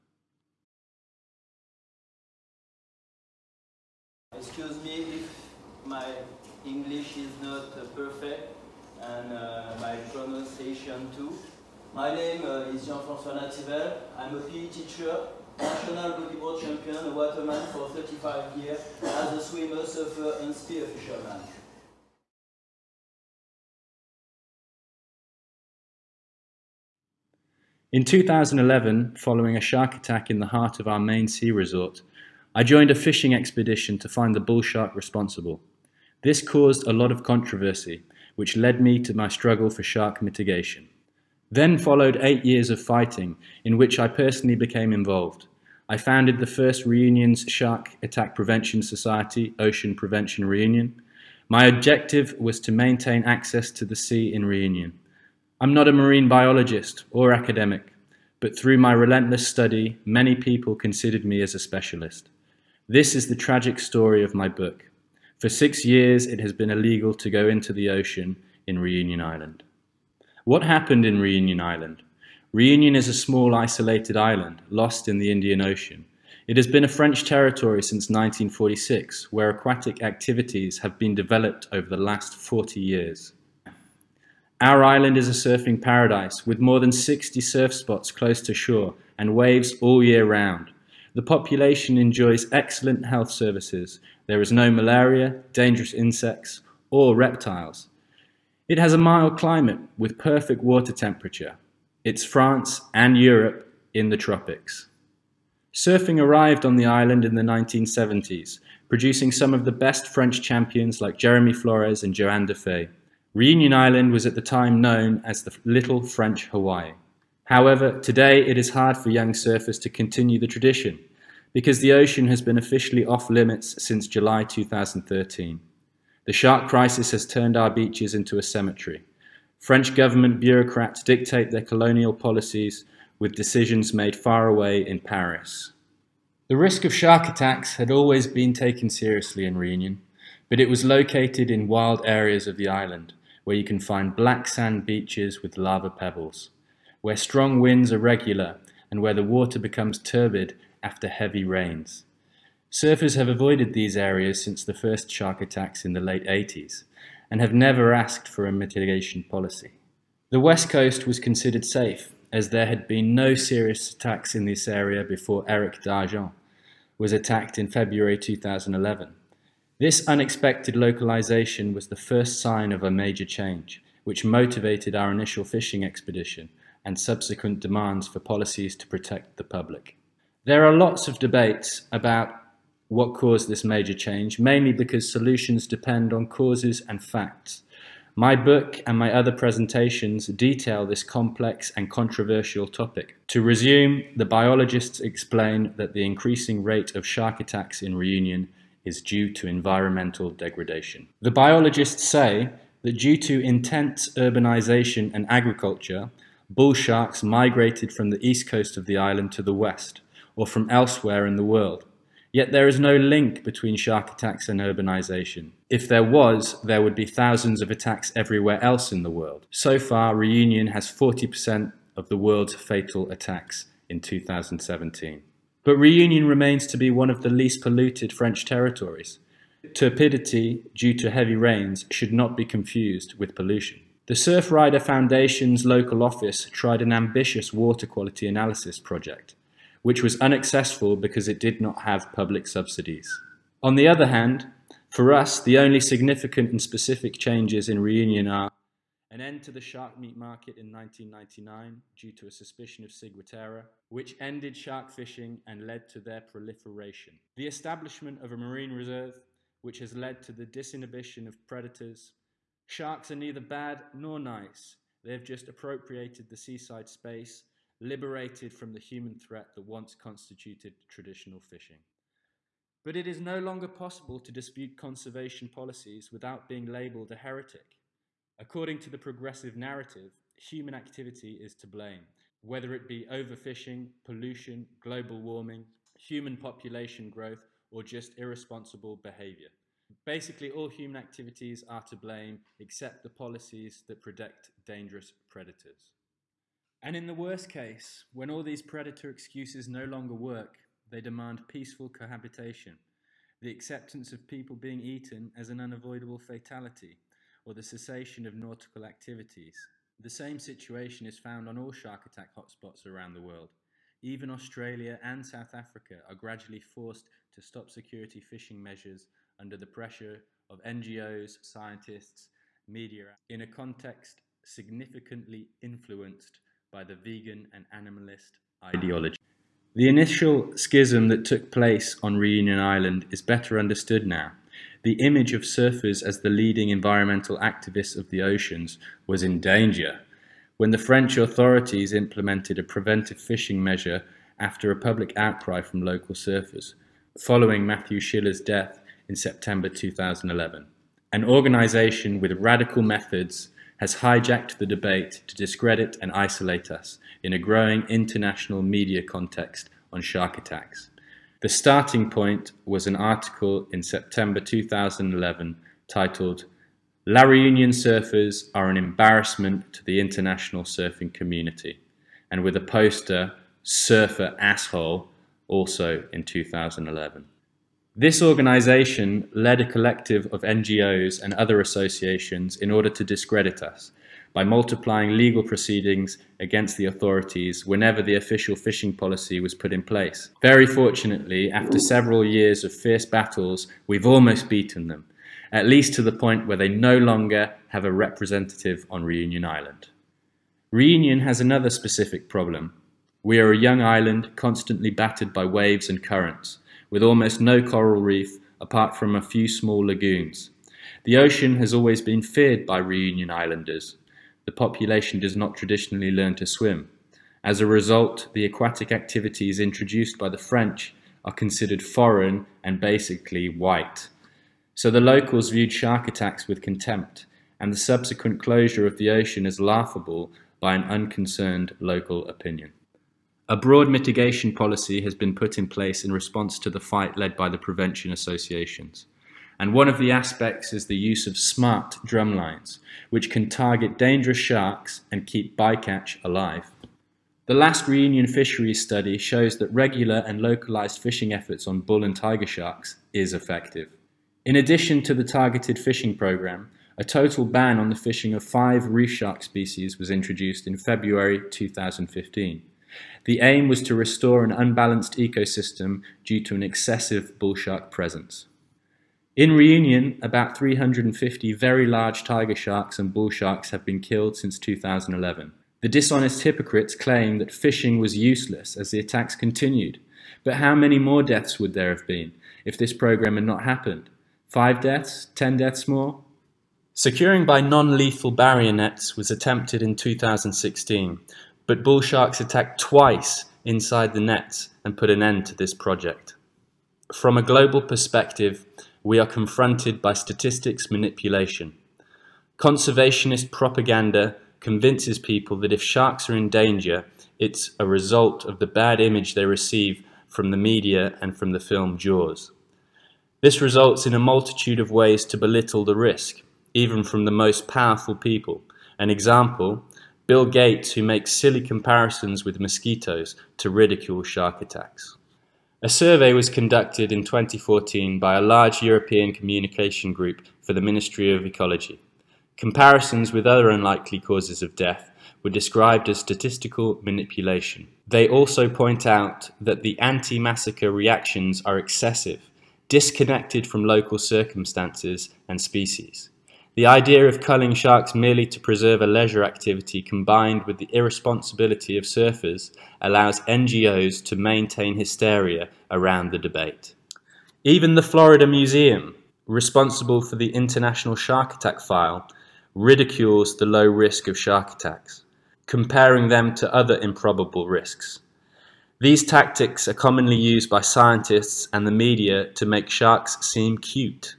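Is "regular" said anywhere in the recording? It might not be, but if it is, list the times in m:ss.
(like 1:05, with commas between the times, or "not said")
2:27, 7:29.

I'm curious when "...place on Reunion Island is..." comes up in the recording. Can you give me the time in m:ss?
5:31.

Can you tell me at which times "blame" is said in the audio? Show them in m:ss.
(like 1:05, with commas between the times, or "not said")
4:41, 4:51.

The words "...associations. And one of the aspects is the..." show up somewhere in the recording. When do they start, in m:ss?
7:18.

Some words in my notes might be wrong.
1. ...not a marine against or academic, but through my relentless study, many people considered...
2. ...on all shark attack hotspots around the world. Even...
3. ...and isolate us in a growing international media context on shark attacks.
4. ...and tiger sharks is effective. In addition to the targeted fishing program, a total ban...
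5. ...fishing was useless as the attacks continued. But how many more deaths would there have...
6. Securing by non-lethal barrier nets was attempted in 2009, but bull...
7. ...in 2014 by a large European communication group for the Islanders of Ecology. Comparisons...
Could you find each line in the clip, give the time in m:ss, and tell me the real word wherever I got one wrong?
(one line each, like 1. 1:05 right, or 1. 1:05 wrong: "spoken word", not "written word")
1. 0:55 wrong: "biologist", not "against"
2. 5:11 right
3. 5:56 right
4. 7:32 right
5. 7:57 right
6. 8:06 wrong: "2016", not "2009"
7. 8:47 wrong: "Ministry", not "Islanders".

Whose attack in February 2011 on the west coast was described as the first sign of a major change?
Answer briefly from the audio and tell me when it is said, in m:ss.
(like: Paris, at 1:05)
Eric Dargent, at 2:45.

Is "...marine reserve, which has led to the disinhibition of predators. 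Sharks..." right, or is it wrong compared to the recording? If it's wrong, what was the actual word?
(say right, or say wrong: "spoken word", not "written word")
right.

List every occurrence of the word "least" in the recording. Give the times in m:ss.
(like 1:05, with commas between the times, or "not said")
3:47, 6:35.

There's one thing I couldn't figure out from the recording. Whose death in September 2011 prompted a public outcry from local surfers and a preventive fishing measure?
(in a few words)
Matthew Schiller.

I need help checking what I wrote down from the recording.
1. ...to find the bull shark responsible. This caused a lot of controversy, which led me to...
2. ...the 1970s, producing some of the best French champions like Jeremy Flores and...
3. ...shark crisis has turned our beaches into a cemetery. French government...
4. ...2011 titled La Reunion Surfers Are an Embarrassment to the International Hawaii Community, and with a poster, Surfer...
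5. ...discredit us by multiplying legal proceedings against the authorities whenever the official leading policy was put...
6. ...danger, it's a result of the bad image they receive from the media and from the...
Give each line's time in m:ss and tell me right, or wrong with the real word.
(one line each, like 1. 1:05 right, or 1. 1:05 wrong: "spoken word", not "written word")
1. 0:33 right
2. 1:47 right
3. 2:06 right
4. 6:04 wrong: "Surfing", not "Hawaii"
5. 6:23 wrong: "fishing", not "leading"
6. 8:26 right.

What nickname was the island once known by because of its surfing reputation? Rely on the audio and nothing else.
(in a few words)
Little French Hawaii.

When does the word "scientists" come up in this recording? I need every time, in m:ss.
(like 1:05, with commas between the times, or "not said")
5:21, 9:30.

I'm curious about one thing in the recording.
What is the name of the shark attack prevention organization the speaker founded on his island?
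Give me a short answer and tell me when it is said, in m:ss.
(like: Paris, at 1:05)
Ocean Prevention Reunion, at 0:49.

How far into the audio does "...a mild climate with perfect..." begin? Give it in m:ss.
1:38.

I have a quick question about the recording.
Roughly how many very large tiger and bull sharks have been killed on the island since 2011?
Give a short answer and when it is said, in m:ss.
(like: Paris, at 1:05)
350, at 7:50.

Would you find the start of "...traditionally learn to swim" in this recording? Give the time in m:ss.
6:55.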